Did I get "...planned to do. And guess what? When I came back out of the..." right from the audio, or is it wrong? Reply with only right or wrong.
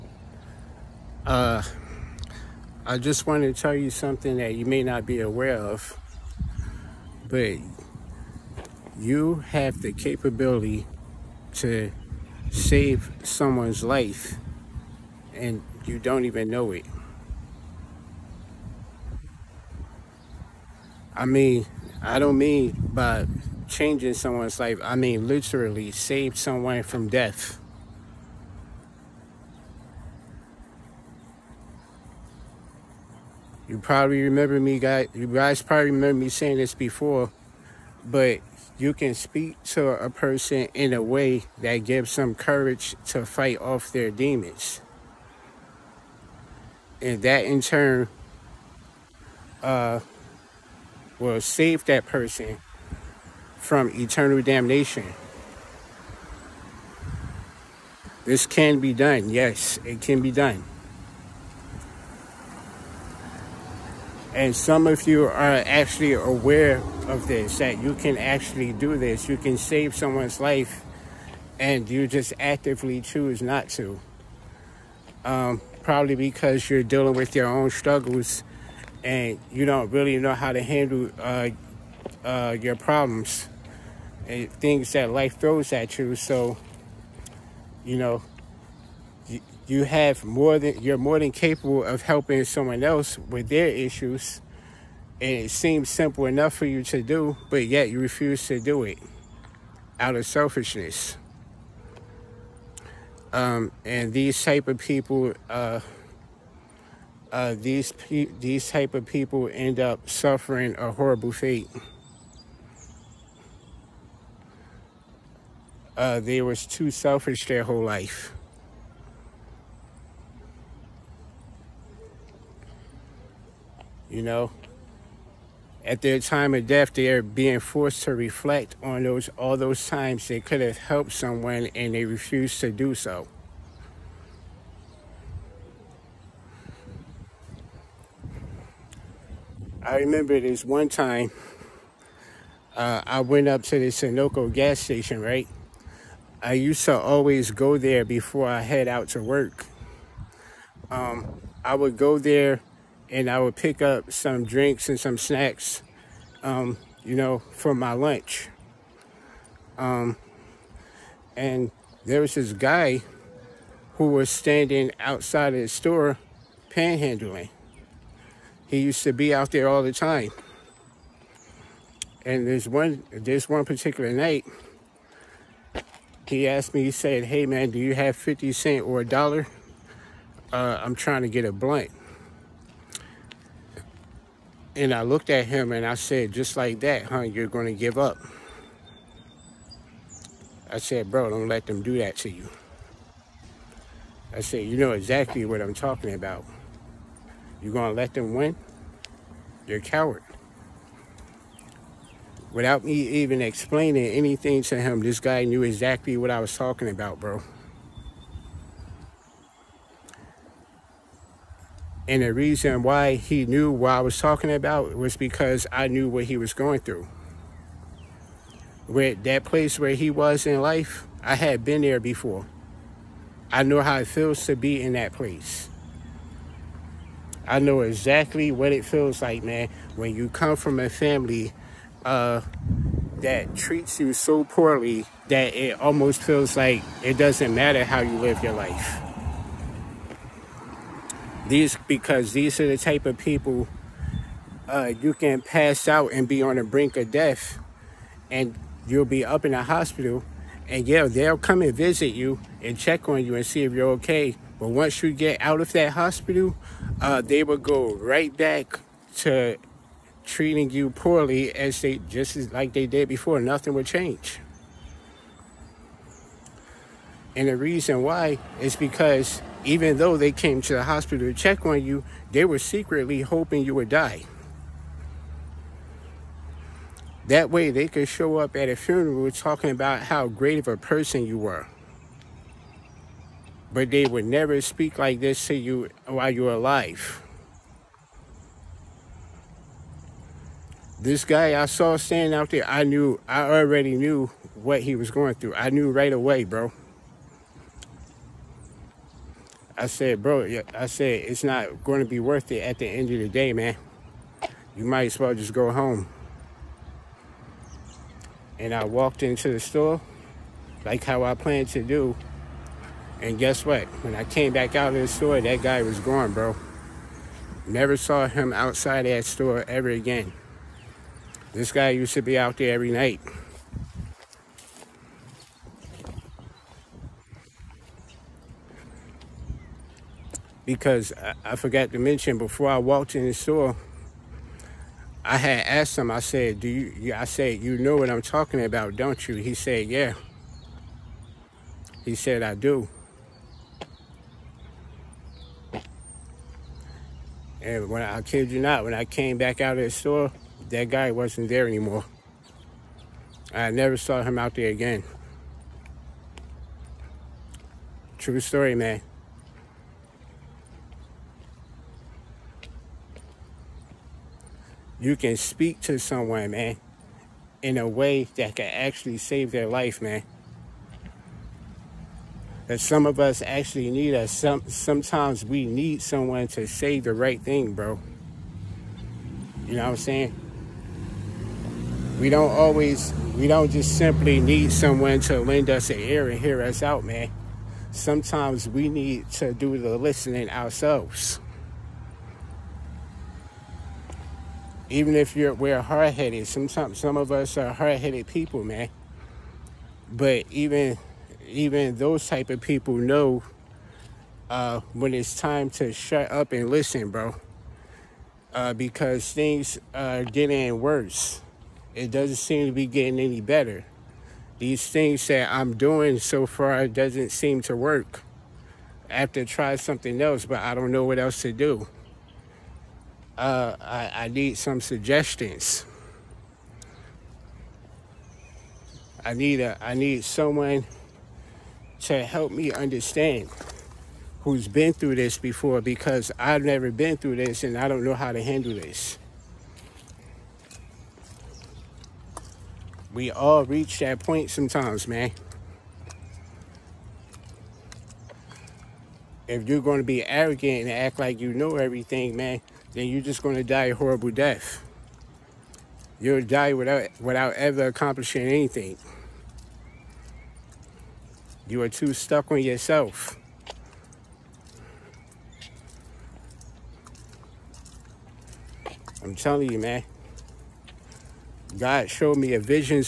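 right.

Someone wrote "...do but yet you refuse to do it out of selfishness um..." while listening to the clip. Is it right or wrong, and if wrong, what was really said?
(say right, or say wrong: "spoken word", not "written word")
right.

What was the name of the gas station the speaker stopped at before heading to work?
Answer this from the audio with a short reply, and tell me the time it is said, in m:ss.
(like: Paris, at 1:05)
Sunoco, at 2:23.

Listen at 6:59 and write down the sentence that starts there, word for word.
I have to try something else, but I don't know what else to do uh, I, I need some suggestions.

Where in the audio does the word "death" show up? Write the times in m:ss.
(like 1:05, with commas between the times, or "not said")
0:27, 2:06, 4:07, 7:34.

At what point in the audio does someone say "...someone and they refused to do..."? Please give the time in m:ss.
2:11.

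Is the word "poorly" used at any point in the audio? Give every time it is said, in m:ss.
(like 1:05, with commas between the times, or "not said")
3:54, 4:20.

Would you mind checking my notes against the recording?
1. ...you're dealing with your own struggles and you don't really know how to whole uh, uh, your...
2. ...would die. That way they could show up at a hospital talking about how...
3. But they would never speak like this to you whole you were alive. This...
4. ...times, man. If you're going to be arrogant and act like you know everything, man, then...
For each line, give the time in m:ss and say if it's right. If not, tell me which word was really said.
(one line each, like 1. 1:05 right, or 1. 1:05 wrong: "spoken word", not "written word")
1. 1:16 wrong: "handle", not "whole"
2. 4:33 wrong: "funeral", not "hospital"
3. 4:43 wrong: "while", not "whole"
4. 7:24 wrong: "sometimes", not "times".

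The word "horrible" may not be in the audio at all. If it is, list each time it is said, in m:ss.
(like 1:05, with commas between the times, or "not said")
1:50, 7:33.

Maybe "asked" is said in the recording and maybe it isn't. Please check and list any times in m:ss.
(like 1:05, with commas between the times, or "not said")
2:56, 5:35.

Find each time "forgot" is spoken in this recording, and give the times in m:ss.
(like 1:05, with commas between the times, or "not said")
5:31.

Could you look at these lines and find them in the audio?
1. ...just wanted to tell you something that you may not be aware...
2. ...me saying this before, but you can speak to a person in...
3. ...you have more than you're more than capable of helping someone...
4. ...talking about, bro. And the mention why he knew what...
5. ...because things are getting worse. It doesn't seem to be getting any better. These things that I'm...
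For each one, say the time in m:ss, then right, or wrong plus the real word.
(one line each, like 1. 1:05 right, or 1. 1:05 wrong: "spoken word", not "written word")
1. 0:02 right
2. 0:36 right
3. 1:29 right
4. 3:26 wrong: "reason", not "mention"
5. 6:48 right.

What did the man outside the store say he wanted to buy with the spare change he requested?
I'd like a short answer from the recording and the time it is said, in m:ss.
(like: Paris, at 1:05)
a blunt, at 3:01.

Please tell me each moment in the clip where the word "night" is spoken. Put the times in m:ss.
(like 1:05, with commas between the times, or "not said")
2:54, 5:22.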